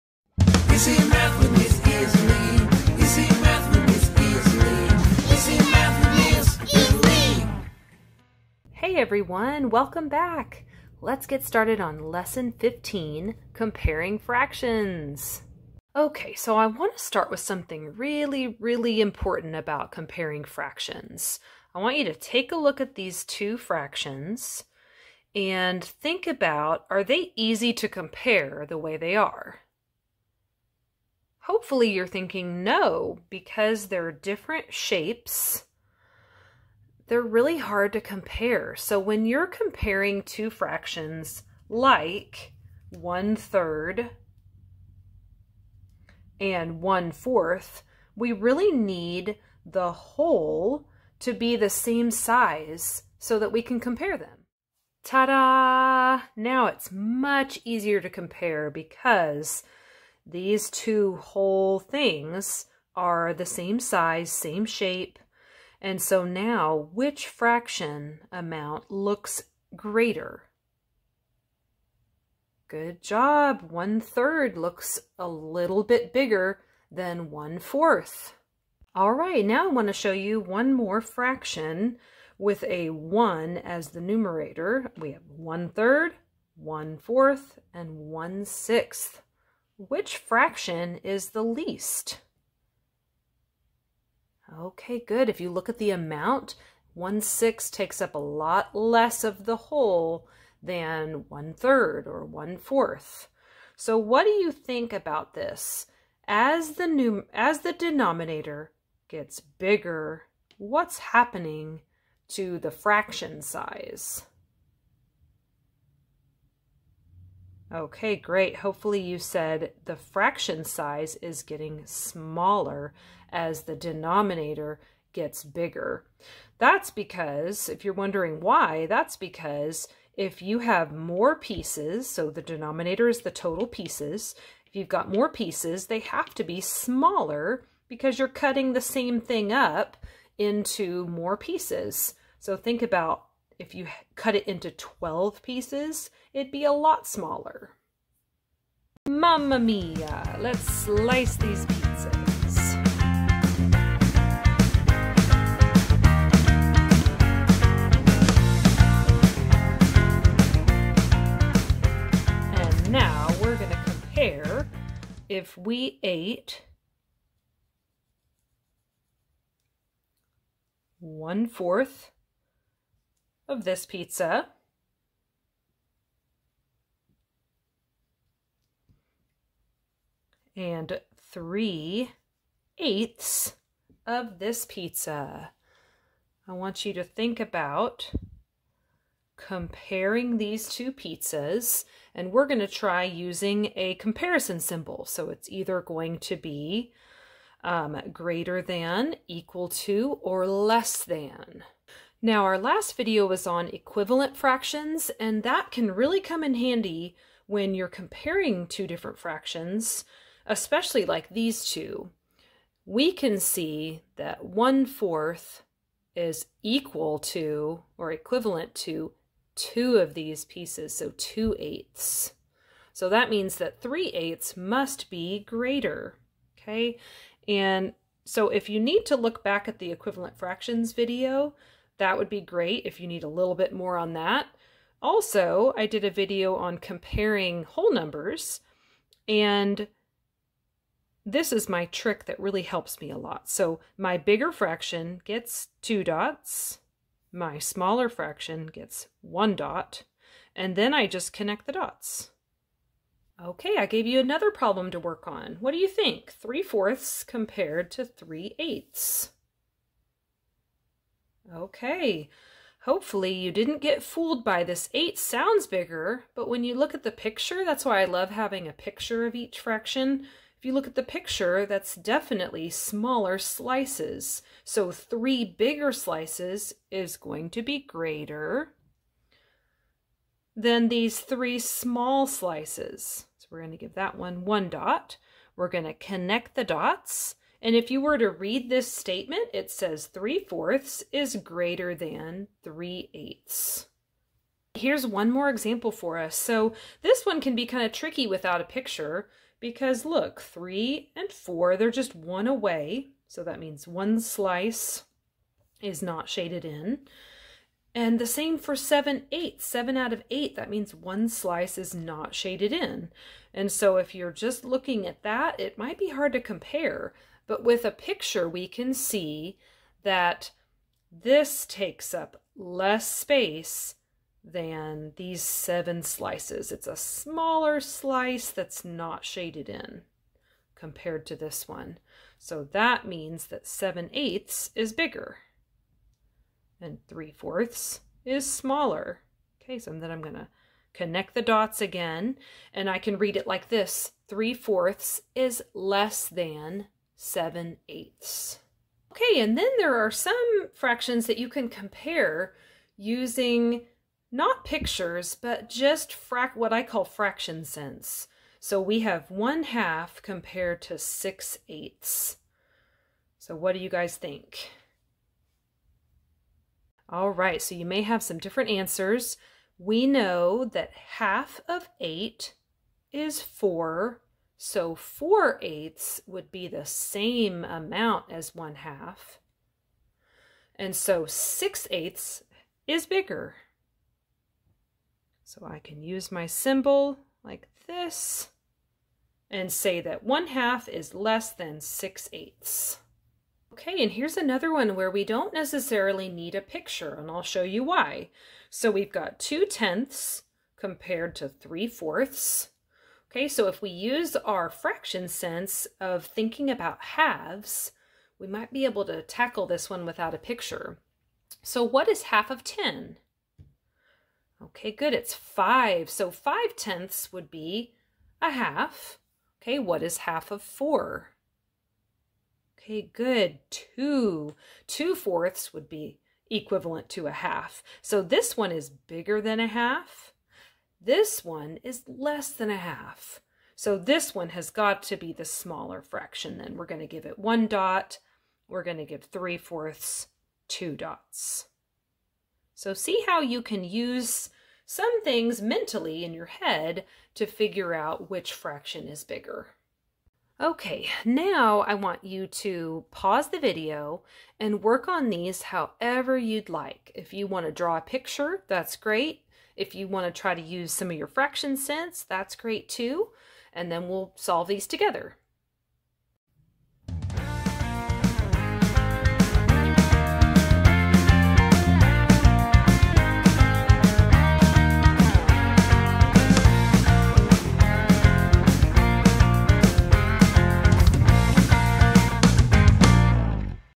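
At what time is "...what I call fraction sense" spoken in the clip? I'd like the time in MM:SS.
05:56.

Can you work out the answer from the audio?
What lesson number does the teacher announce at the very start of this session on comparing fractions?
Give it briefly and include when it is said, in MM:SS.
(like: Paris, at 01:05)
15, at 00:12.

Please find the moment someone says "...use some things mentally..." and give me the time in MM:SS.
07:23.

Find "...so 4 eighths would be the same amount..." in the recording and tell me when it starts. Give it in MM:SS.
06:14.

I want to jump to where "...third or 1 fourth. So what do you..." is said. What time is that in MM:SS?
01:41.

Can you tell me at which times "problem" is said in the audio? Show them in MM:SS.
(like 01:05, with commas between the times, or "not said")
04:14.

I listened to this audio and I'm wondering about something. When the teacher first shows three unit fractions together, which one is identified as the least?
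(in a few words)
1/6.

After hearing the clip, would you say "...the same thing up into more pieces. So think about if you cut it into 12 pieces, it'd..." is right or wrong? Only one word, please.
right.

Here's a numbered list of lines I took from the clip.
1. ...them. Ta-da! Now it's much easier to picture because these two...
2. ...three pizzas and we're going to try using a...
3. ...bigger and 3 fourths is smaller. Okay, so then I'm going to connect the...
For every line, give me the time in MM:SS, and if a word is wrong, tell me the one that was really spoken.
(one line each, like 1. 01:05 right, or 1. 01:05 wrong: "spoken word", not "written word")
1. 00:54 wrong: "compare", not "picture"
2. 03:10 wrong: "two", not "three"
3. 05:34 right.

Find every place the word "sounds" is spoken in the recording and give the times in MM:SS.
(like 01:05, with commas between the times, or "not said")
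04:25.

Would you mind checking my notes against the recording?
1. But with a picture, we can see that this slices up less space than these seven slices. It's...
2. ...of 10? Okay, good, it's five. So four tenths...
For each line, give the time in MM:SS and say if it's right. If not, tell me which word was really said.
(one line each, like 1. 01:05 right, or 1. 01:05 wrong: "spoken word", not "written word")
1. 05:17 wrong: "takes", not "slices"
2. 06:52 wrong: "five", not "four".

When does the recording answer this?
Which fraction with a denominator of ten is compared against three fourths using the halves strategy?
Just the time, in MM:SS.
06:39.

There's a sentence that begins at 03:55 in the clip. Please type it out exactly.
Also, I did a video on comparing whole numbers, and this is my trick that really helps me a lot.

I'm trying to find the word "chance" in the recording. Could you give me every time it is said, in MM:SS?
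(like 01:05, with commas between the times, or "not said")
not said.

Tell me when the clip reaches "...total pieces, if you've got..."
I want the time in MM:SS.
02:13.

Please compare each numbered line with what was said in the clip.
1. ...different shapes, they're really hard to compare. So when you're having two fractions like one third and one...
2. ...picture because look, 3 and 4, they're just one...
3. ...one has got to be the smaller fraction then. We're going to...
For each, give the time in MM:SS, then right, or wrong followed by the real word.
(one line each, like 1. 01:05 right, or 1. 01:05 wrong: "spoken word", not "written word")
1. 00:34 wrong: "comparing", not "having"
2. 04:58 right
3. 07:14 right.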